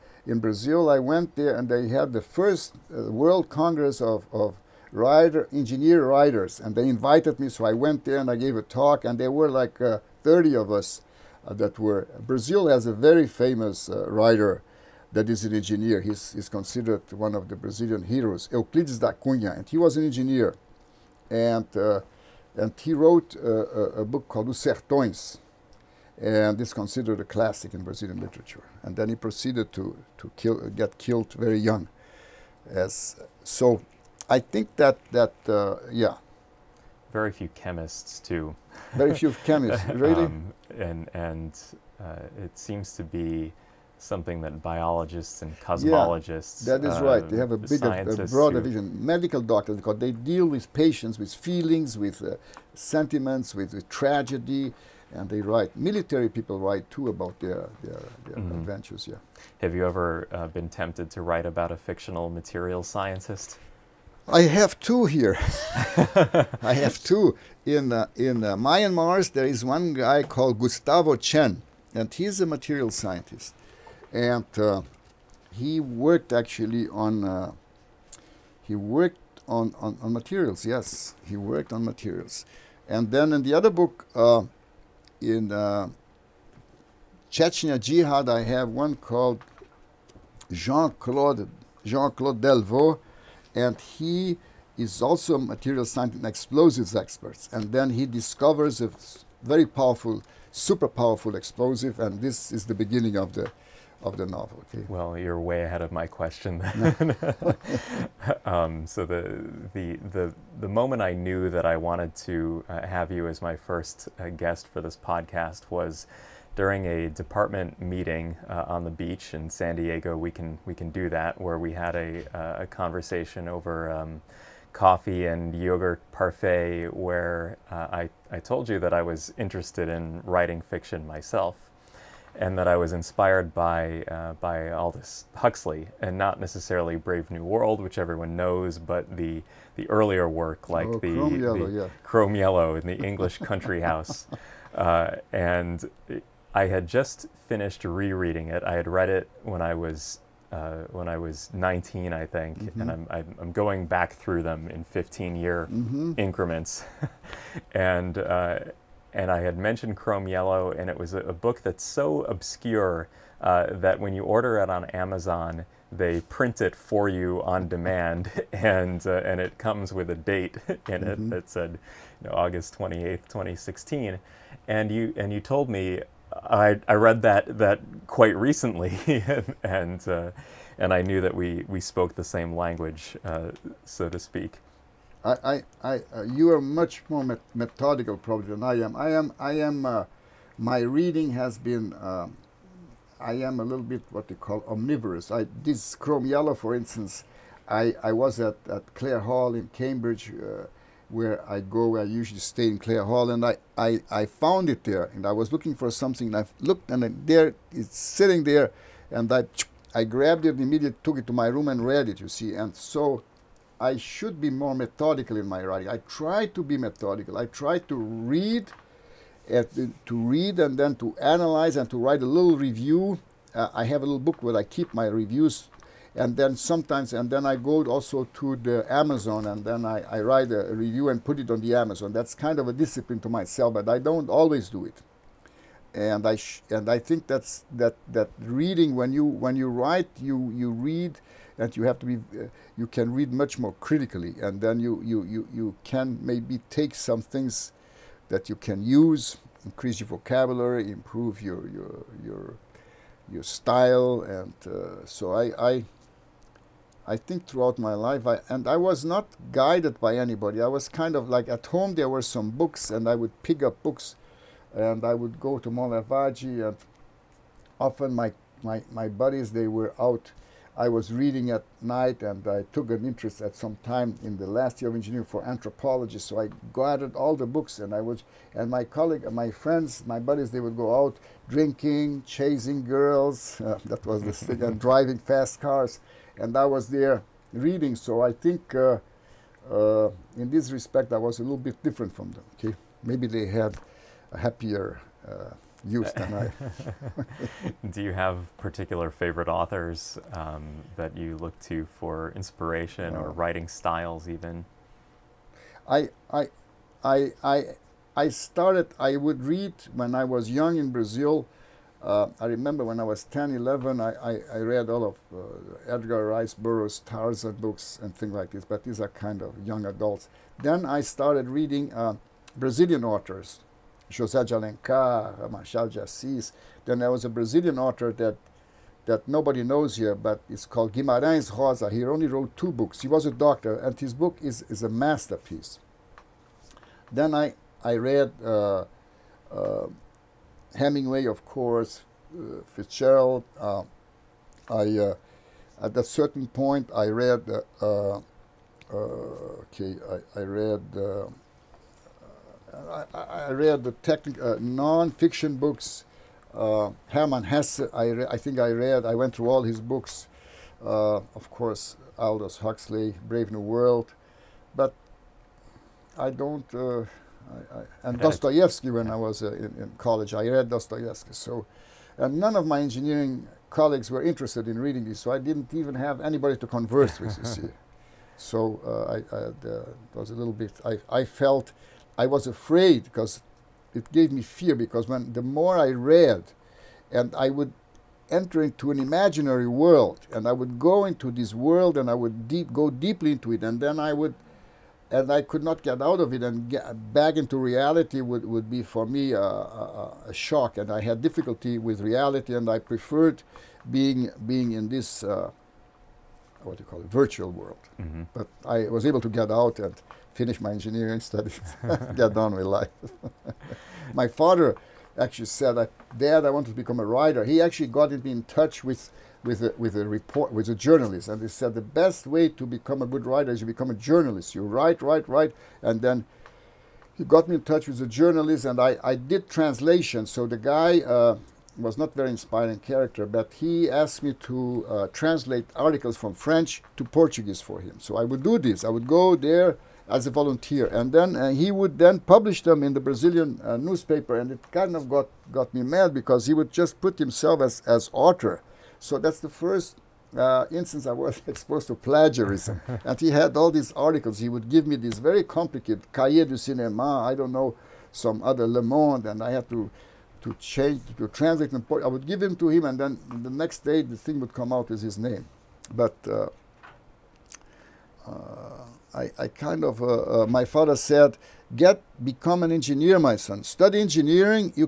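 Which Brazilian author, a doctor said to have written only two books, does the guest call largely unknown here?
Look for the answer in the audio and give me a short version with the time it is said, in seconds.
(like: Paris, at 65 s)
Guimarães Rosa, at 330 s.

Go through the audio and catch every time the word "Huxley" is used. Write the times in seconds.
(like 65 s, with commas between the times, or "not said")
135 s, 362 s.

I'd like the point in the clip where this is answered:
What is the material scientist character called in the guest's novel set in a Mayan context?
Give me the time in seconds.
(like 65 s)
70 s.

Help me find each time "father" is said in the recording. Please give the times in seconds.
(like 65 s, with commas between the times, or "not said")
414 s, 470 s.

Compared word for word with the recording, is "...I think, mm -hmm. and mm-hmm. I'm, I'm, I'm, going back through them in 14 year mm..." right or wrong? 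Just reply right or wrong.
wrong.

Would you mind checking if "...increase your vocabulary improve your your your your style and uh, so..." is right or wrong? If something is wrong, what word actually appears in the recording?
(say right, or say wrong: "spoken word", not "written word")
right.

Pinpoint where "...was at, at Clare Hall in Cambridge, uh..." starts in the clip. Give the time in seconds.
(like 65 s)
198 s.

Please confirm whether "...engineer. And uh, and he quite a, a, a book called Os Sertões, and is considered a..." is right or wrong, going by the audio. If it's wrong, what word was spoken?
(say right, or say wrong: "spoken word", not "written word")
wrong: "wrote", not "quite".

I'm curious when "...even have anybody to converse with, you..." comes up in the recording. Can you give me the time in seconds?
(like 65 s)
375 s.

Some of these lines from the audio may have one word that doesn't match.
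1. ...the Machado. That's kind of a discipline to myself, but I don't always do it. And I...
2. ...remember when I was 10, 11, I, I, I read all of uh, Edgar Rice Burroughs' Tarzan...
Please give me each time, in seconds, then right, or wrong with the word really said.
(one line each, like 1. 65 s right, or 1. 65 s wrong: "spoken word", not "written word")
1. 231 s wrong: "Amazon", not "Machado"
2. 312 s right.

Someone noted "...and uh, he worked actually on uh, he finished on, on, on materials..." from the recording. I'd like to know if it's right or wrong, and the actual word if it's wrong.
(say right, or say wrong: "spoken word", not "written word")
wrong: "worked", not "finished".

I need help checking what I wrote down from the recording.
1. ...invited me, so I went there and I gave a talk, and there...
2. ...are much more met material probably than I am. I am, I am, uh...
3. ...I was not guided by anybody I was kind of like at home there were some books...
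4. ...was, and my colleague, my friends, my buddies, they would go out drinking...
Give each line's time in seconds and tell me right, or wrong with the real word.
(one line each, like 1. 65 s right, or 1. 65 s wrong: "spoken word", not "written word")
1. 6 s right
2. 186 s wrong: "methodical", not "material"
3. 258 s right
4. 277 s right.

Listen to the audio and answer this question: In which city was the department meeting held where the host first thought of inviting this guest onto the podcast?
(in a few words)
San Diego.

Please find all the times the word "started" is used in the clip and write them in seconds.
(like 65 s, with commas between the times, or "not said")
308 s, 321 s.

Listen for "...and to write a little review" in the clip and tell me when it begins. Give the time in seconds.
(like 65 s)
221 s.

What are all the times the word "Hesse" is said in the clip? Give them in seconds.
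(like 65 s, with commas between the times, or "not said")
357 s.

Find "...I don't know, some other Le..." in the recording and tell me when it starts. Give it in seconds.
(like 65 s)
457 s.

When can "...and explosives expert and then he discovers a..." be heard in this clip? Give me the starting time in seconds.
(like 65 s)
96 s.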